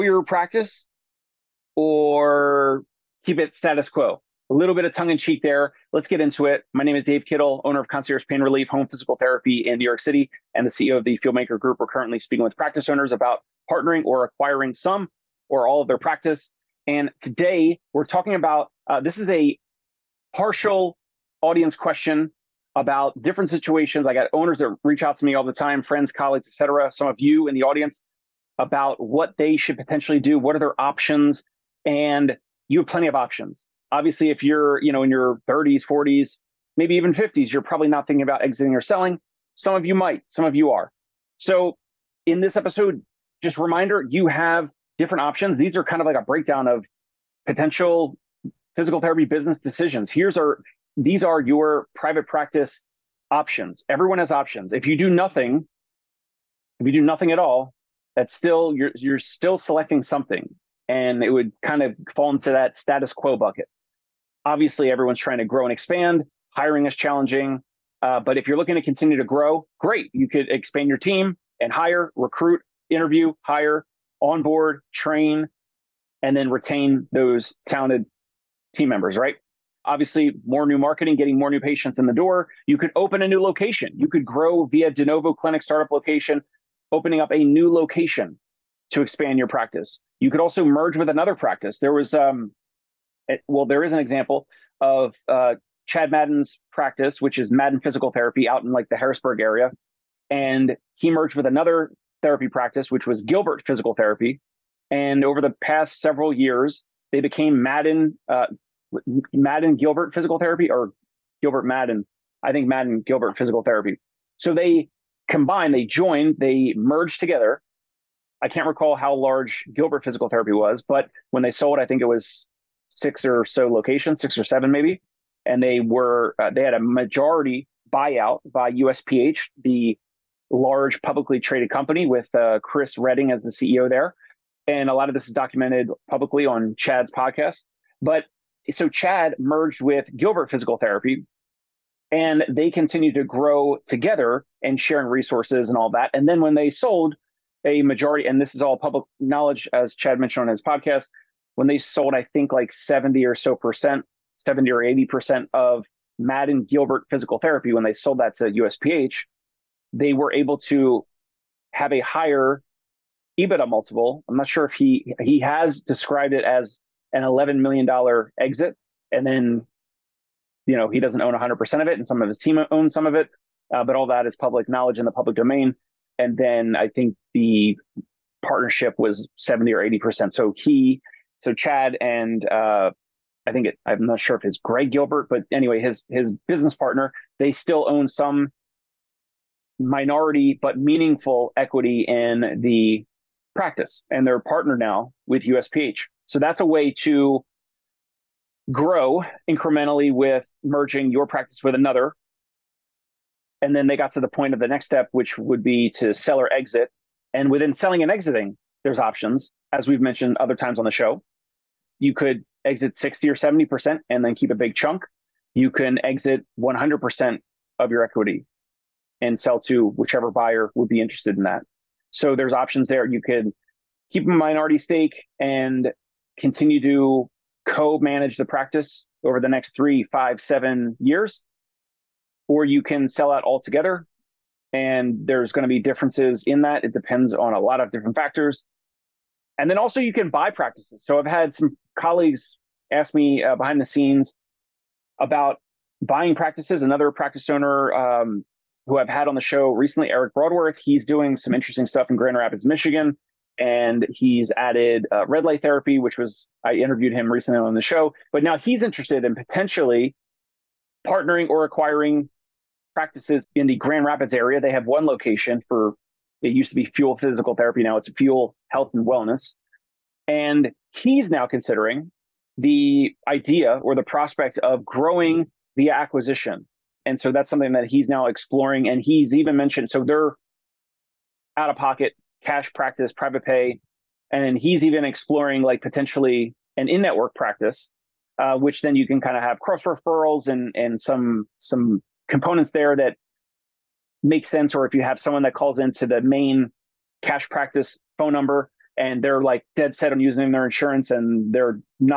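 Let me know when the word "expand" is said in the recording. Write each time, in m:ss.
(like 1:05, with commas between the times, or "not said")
1:05, 1:10, 1:29.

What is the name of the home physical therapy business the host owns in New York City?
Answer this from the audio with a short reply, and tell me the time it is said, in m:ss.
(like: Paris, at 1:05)
Concierge Pain Relief Home Physical Therapy, at 0:07.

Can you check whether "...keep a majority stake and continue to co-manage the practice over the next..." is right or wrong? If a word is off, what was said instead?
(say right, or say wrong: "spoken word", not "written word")
wrong: "minority", not "majority".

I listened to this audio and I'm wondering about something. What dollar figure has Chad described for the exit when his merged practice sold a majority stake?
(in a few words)
11 million dollars.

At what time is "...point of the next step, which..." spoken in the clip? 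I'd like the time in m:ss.
3:24.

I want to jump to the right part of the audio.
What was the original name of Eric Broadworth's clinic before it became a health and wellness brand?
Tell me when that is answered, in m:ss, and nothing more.
4:26.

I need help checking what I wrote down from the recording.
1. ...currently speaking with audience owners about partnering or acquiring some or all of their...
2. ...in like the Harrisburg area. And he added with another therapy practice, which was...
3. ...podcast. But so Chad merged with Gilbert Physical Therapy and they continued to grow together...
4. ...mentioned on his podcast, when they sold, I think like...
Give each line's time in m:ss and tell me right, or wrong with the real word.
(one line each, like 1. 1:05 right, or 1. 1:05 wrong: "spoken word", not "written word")
1. 0:11 wrong: "practice", not "audience"
2. 1:38 wrong: "merged", not "added"
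3. 2:17 right
4. 2:30 right.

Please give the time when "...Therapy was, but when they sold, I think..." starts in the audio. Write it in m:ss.
2:00.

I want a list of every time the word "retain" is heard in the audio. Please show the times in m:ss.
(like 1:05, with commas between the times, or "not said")
1:16.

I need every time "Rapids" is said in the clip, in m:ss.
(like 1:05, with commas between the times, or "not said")
4:12, 4:24.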